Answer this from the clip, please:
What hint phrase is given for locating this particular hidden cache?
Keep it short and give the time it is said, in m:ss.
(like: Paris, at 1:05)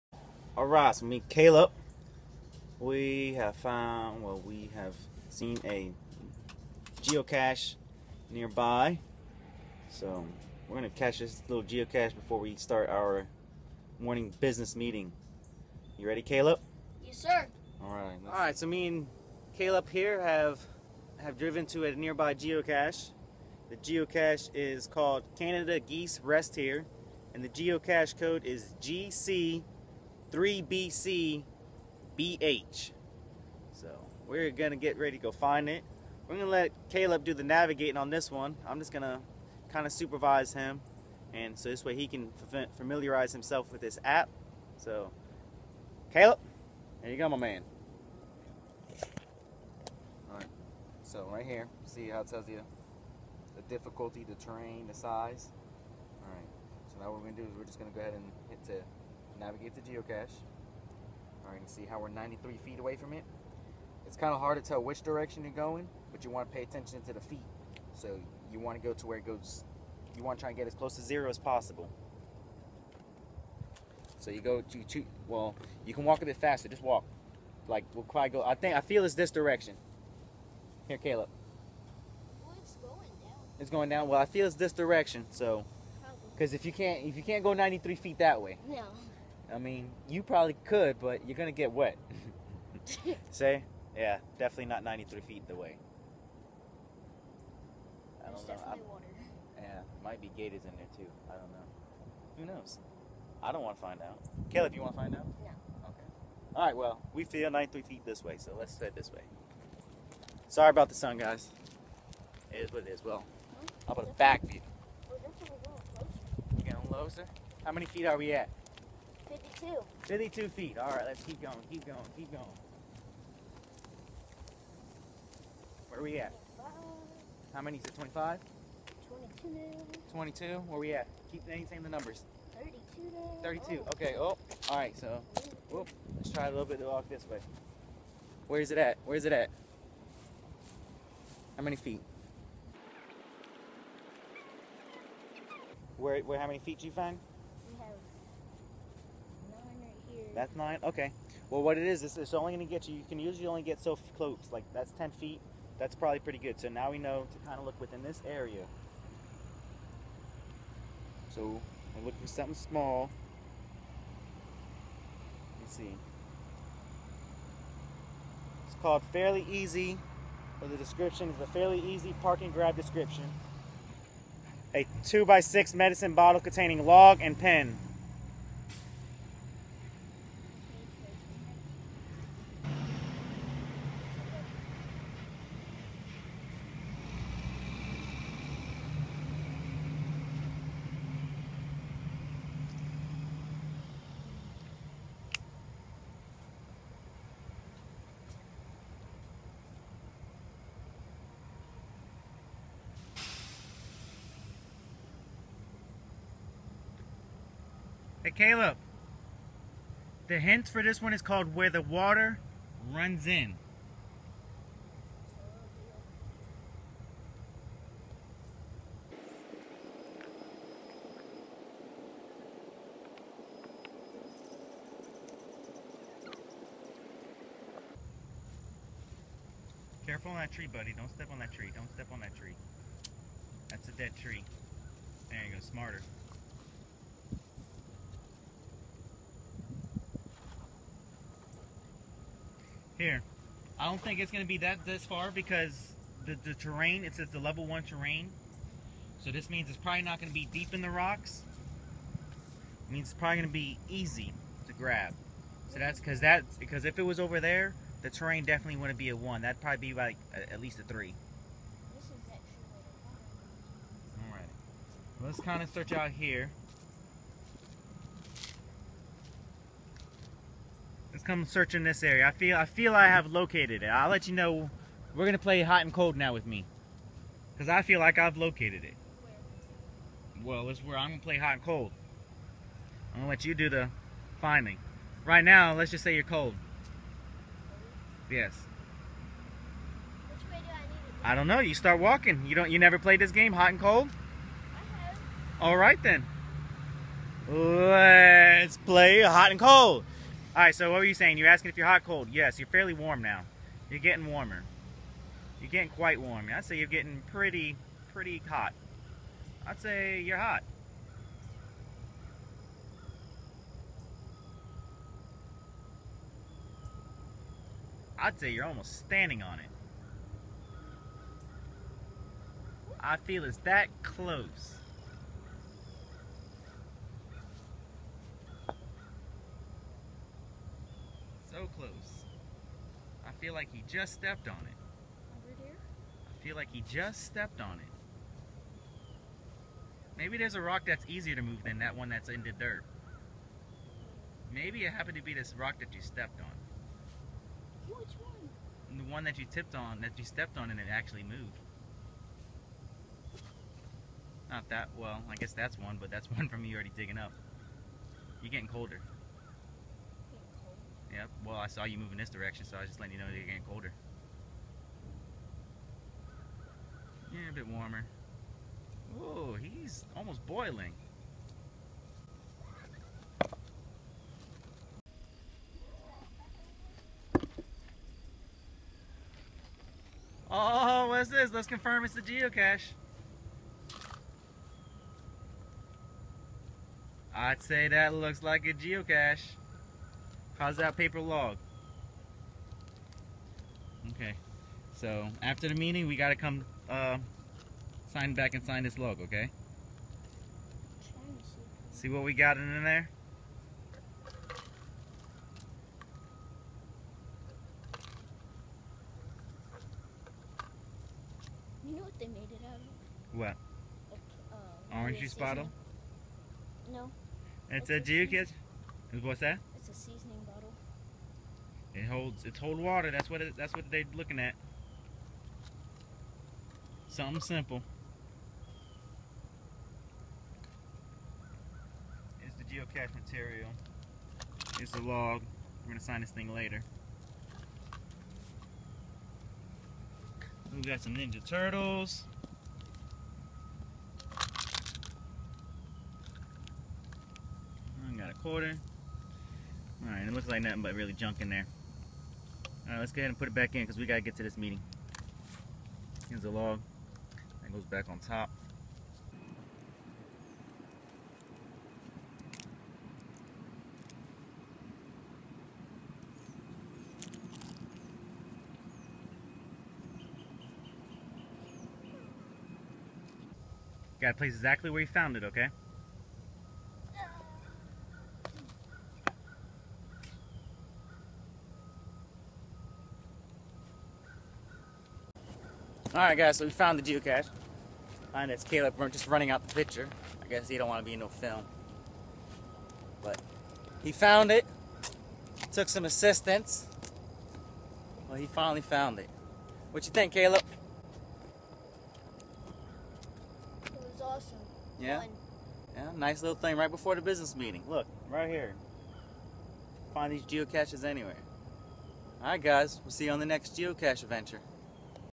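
Where the Water Runs In, at 3:31.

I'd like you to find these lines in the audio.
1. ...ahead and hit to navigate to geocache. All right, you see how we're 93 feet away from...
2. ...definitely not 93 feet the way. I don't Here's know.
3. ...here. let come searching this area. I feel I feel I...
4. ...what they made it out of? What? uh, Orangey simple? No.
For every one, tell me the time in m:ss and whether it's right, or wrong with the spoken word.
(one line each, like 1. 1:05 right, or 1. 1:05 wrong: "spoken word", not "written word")
1. 0:58 right
2. 1:34 wrong: "There", not "Here"
3. 4:26 right
4. 6:52 wrong: "spottle", not "simple".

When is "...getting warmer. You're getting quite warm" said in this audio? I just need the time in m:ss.
5:04.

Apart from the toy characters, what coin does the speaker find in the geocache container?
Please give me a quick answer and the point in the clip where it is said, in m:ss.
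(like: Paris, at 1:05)
a quarter, at 7:28.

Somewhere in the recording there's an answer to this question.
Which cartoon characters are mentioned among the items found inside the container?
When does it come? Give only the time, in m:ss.
7:21.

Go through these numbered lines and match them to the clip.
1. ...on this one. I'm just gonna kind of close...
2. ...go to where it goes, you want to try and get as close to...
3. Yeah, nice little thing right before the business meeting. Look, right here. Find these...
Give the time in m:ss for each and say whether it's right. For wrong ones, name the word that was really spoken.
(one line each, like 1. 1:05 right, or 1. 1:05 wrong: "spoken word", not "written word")
1. 0:37 wrong: "supervise", not "close"
2. 1:08 right
3. 8:25 right.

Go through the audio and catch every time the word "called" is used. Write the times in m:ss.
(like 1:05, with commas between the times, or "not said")
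0:24, 2:48, 3:31.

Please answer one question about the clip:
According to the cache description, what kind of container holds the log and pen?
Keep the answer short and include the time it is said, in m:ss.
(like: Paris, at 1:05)
medicine bottle, at 2:55.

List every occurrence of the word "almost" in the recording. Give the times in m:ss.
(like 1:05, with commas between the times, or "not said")
5:18, 6:10.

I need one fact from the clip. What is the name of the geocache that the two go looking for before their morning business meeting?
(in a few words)
Canada Geese Rest Here.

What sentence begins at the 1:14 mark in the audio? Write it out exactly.
So you go, to choose, well, you can walk a bit faster, just walk.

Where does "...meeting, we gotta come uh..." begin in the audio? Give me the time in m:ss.
6:35.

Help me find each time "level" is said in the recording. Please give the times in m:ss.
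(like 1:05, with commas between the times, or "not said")
4:07.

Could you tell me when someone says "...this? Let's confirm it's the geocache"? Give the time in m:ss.
6:21.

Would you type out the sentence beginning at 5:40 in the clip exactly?
Maybe there's a rock that's easier to move than that one that's in the dirt.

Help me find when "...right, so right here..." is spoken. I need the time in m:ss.
0:50.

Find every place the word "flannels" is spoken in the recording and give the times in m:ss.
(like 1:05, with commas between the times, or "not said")
not said.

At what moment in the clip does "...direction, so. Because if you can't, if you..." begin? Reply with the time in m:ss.
1:24.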